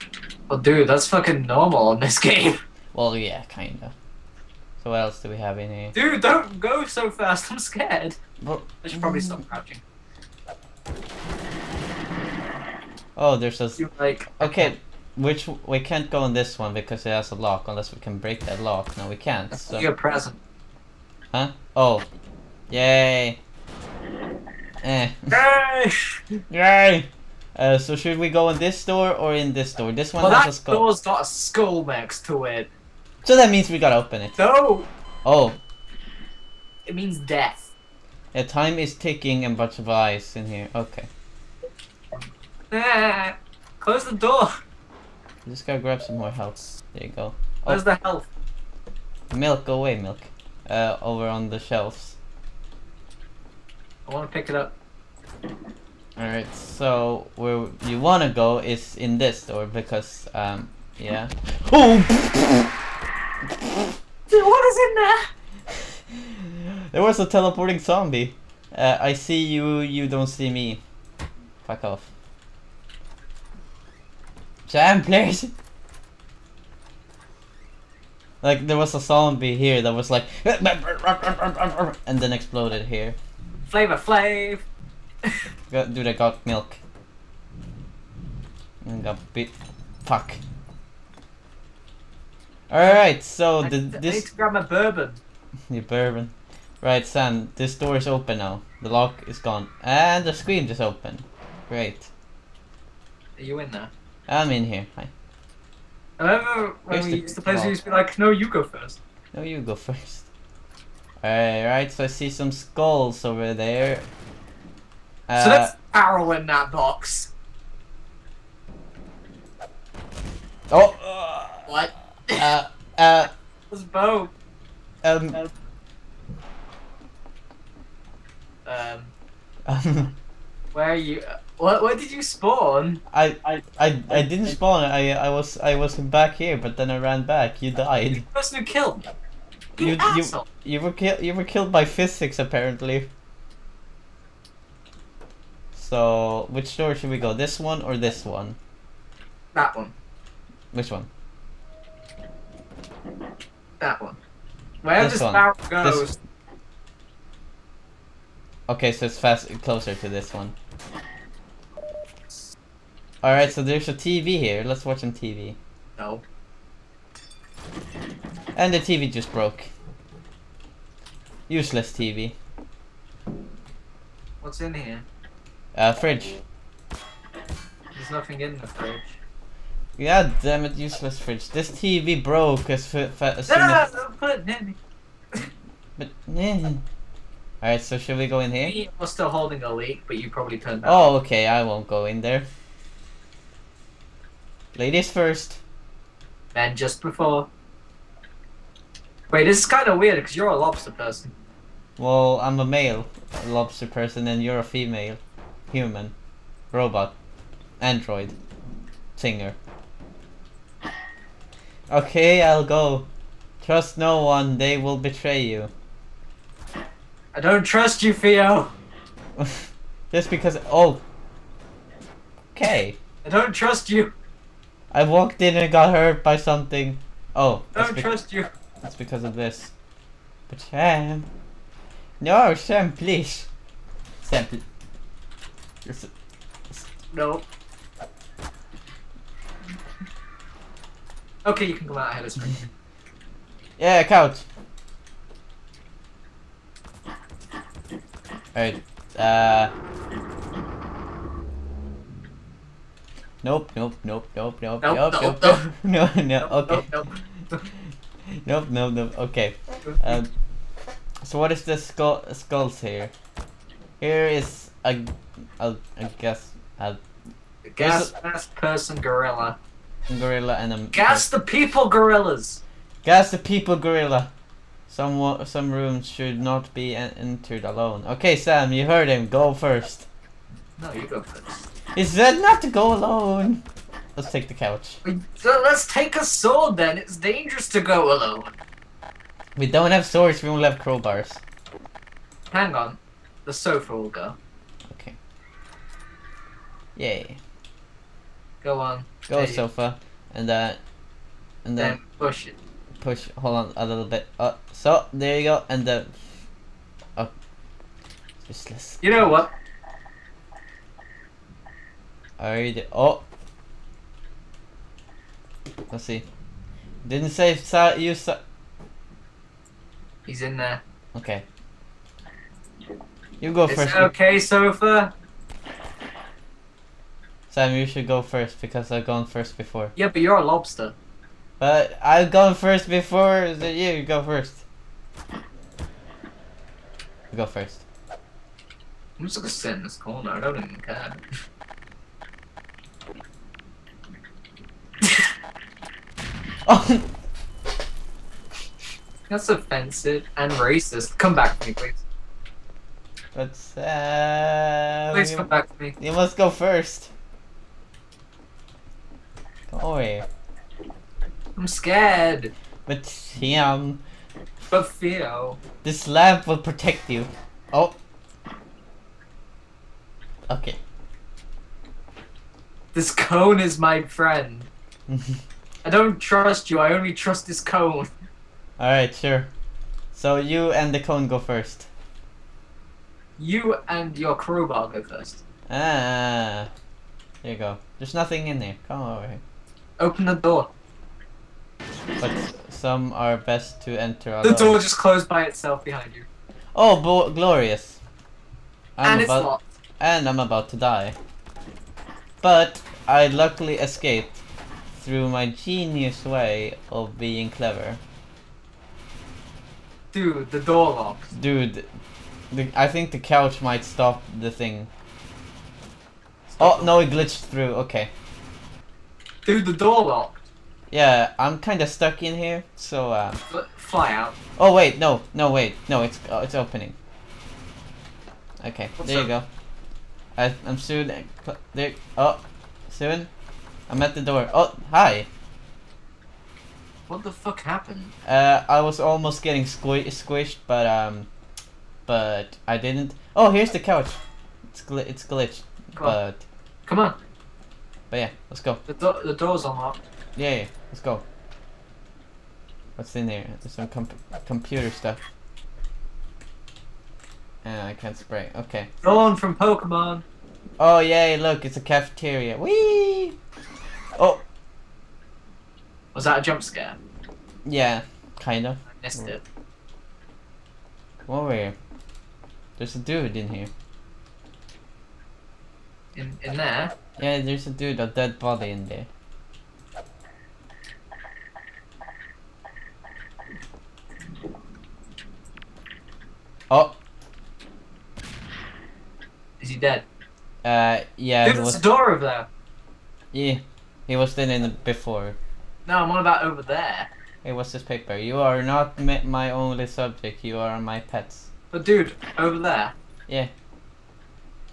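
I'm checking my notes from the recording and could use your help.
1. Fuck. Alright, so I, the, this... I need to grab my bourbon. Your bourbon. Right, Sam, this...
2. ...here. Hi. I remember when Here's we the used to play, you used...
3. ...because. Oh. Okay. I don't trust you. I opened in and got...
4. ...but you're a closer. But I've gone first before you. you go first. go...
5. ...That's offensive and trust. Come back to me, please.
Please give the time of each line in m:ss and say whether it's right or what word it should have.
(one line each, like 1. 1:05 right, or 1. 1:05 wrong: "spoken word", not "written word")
1. 1:30 right
2. 1:44 right
3. 3:40 wrong: "walked", not "opened"
4. 5:30 wrong: "lobster", not "closer"
5. 5:49 wrong: "racist", not "trust".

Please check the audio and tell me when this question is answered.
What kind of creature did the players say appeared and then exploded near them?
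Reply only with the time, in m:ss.
1:06.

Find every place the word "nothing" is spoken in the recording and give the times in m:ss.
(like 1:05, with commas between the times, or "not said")
2:58, 6:28.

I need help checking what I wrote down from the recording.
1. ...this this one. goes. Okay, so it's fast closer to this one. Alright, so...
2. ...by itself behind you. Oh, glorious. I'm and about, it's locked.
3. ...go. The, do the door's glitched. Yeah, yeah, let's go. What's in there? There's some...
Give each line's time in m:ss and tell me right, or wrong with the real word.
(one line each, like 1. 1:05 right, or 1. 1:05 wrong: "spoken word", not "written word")
1. 2:35 right
2. 6:35 right
3. 7:28 wrong: "unlocked", not "glitched".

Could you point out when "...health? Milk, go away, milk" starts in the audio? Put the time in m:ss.
0:47.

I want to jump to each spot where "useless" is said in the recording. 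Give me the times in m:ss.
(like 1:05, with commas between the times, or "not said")
2:51, 3:00, 5:08.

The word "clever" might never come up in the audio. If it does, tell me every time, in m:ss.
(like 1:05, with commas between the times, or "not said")
6:47.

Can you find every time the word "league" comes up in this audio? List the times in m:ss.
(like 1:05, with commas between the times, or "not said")
not said.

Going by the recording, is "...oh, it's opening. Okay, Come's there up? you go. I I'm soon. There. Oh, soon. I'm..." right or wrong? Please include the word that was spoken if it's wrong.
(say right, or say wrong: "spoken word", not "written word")
wrong: "What", not "Come".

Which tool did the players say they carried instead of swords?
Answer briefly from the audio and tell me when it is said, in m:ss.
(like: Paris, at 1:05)
Crowbars, at 4:50.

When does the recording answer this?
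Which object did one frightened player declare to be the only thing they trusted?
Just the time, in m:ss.
6:16.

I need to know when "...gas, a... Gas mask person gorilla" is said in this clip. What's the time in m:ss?
4:26.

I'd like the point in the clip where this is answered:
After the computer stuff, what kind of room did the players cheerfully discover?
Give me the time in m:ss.
7:41.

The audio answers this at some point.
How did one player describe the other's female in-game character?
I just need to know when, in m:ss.
3:24.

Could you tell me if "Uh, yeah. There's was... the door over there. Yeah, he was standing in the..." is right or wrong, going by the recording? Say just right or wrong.
right.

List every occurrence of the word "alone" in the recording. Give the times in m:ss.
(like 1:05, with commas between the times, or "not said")
4:37, 4:42, 4:48, 6:34.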